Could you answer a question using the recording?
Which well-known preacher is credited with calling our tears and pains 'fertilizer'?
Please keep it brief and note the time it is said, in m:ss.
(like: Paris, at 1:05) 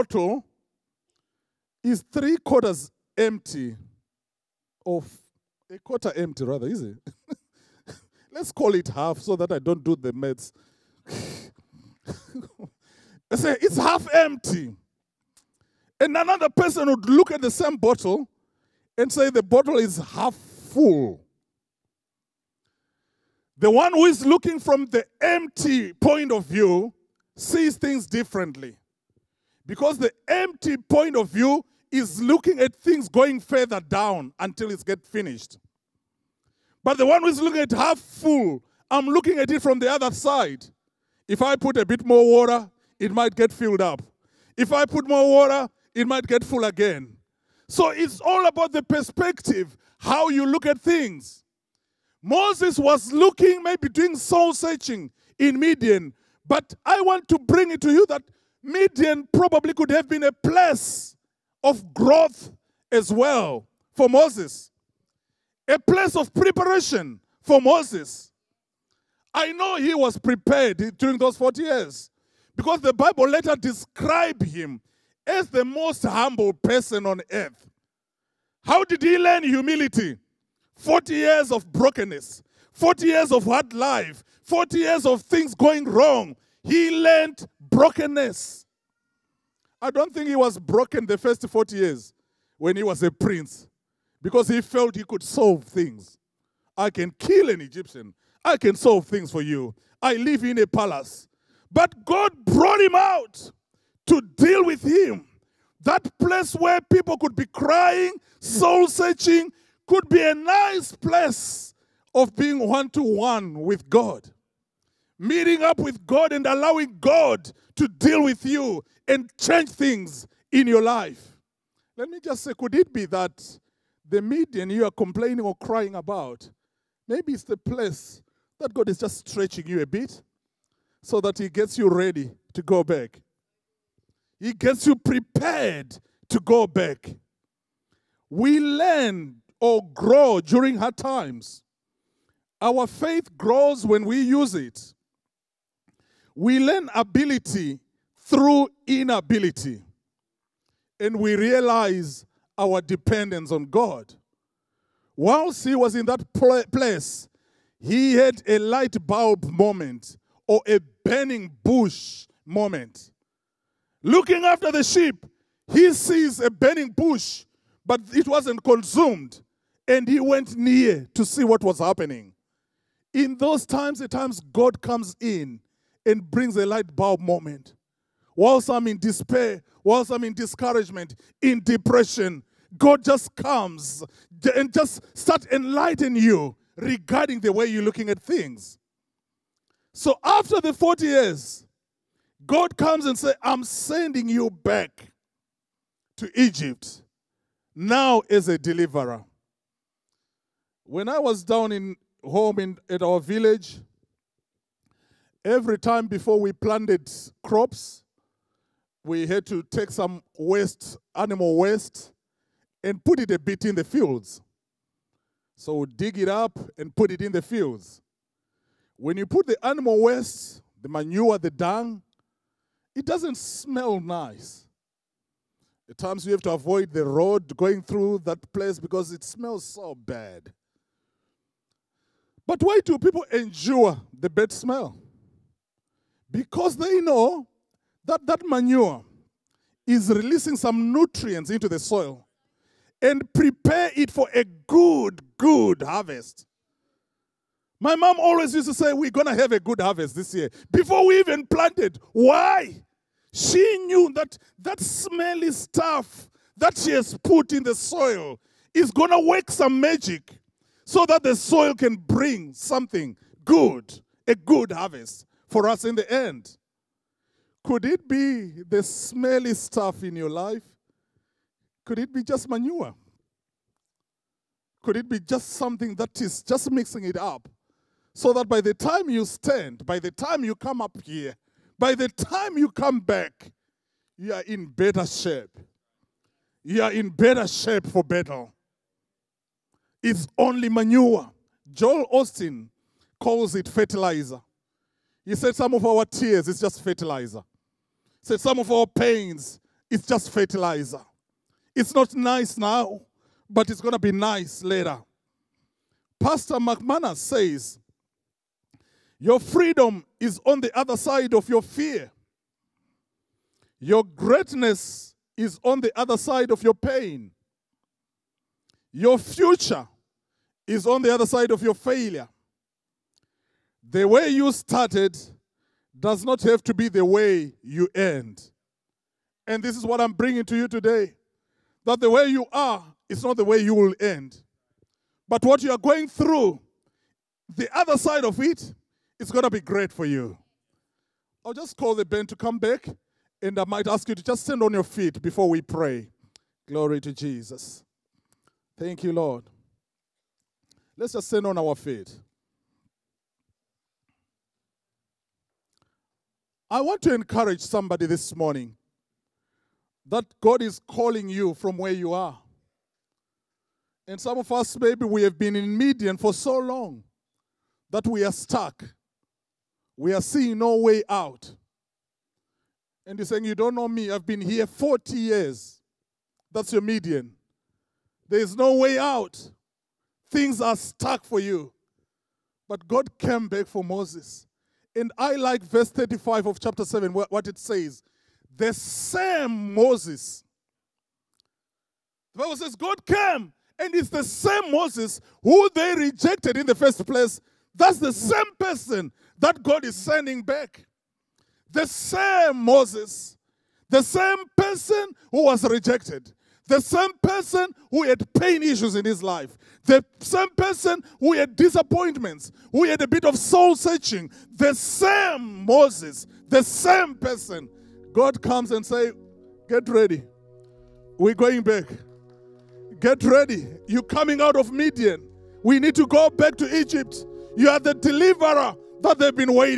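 Joel Osteen, at 4:51.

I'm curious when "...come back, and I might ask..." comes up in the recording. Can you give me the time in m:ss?
5:42.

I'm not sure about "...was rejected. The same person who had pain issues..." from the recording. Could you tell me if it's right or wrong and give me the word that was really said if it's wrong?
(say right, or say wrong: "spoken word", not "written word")
right.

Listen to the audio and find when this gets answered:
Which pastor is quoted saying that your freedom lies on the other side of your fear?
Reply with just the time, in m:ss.
5:06.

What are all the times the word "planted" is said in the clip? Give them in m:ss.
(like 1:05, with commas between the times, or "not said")
3:26, 4:11.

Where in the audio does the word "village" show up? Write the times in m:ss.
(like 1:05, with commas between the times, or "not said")
3:23.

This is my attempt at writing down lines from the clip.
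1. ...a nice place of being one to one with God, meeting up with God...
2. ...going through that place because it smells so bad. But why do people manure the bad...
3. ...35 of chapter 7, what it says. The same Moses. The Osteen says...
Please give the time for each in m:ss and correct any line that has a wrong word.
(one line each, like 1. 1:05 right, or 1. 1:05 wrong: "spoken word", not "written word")
1. 1:50 right
2. 3:47 wrong: "endure", not "manure"
3. 6:25 wrong: "Bible", not "Osteen".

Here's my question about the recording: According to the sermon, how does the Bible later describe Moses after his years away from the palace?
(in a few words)
most humble person on earth.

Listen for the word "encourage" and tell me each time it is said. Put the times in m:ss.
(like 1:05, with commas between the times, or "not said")
5:57.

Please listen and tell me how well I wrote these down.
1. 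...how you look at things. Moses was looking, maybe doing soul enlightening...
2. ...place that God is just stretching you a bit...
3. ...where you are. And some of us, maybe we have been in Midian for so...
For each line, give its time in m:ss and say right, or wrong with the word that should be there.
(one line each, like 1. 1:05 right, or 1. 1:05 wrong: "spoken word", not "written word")
1. 0:49 wrong: "searching", not "enlightening"
2. 2:07 right
3. 6:01 right.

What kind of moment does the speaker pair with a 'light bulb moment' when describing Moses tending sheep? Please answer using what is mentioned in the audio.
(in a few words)
burning bush moment.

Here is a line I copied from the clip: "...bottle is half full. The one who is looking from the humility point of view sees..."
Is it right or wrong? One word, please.
wrong.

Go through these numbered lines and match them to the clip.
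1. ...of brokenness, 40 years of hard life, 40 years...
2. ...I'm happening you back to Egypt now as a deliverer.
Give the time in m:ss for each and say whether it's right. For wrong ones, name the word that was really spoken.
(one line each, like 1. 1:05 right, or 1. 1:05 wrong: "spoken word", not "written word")
1. 1:21 right
2. 3:13 wrong: "sending", not "happening".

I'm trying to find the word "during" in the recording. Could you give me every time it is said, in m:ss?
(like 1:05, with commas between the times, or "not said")
1:10, 2:20.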